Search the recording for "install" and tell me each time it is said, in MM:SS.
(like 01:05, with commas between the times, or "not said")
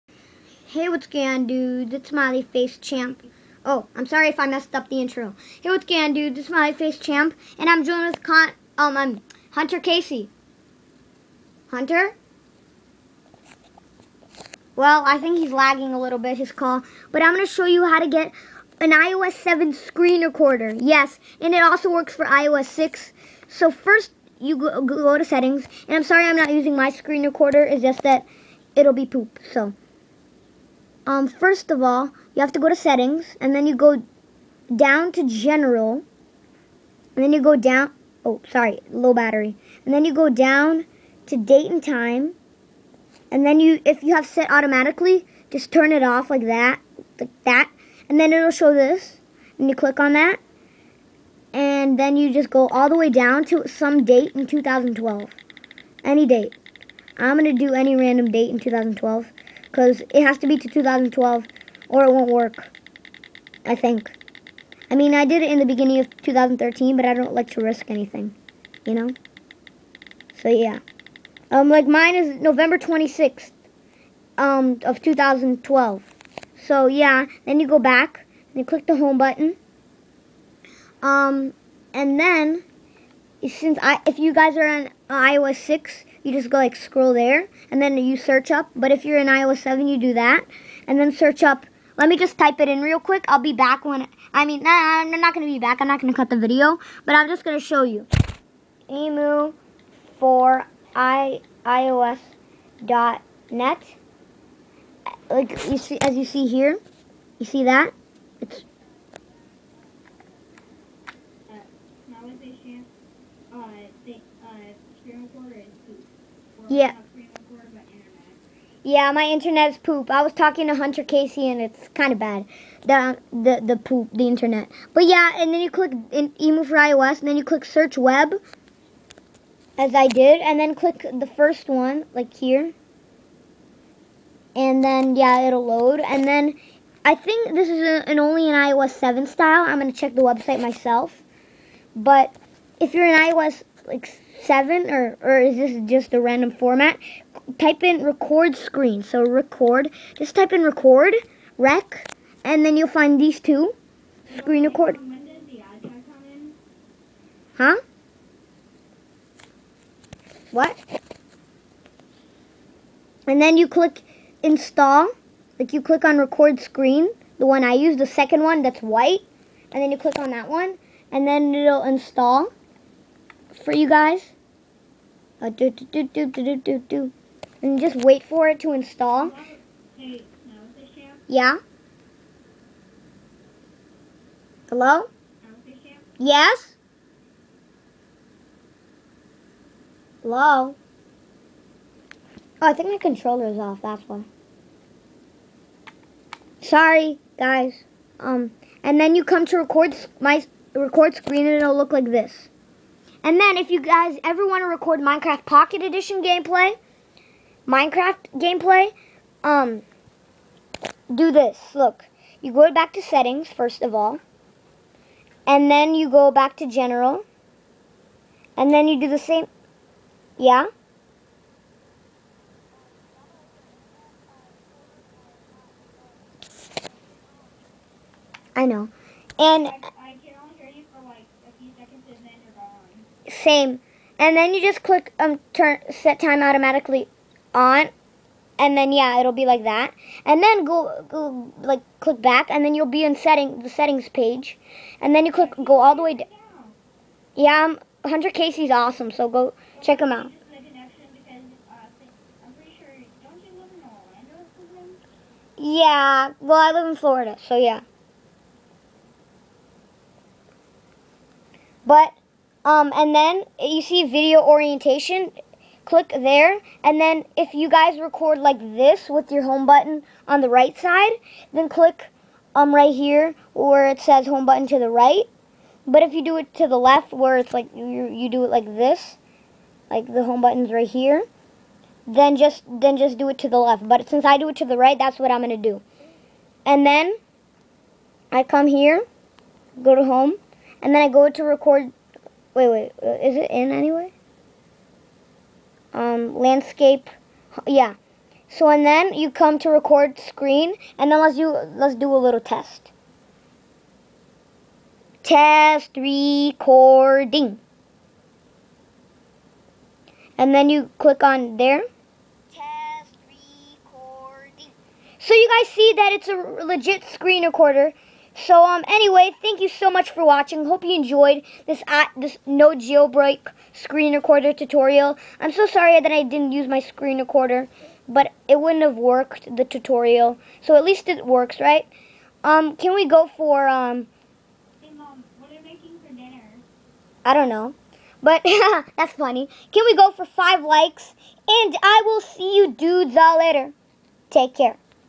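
02:44, 02:51, 02:58.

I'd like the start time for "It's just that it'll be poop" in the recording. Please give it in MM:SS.
00:27.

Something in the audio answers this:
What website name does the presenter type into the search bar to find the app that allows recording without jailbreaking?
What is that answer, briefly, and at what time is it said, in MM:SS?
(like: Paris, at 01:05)
Emu for iOS, at 01:38.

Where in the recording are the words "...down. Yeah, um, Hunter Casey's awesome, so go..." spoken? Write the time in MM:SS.
04:06.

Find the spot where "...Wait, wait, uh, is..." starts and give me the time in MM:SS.
04:52.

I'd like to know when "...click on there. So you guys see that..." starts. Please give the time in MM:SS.
05:10.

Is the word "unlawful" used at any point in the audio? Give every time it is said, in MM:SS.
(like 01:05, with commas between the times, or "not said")
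not said.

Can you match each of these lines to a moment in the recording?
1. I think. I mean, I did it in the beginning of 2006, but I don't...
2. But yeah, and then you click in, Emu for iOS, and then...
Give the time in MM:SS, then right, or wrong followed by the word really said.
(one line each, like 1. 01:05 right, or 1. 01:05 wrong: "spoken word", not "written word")
1. 01:03 wrong: "2013", not "2006"
2. 02:04 right.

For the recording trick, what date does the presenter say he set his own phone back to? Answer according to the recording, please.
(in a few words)
November 26th, 2012.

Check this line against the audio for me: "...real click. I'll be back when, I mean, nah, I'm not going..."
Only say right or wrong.
wrong.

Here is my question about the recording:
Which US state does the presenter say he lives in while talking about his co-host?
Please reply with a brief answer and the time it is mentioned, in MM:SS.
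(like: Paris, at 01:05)
Florida, at 04:16.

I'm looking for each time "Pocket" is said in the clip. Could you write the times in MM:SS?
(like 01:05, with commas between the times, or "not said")
03:25.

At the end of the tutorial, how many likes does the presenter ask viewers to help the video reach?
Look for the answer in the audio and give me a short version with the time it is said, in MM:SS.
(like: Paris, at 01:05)
5, at 05:40.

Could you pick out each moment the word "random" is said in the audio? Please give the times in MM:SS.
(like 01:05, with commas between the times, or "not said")
00:57, 02:26.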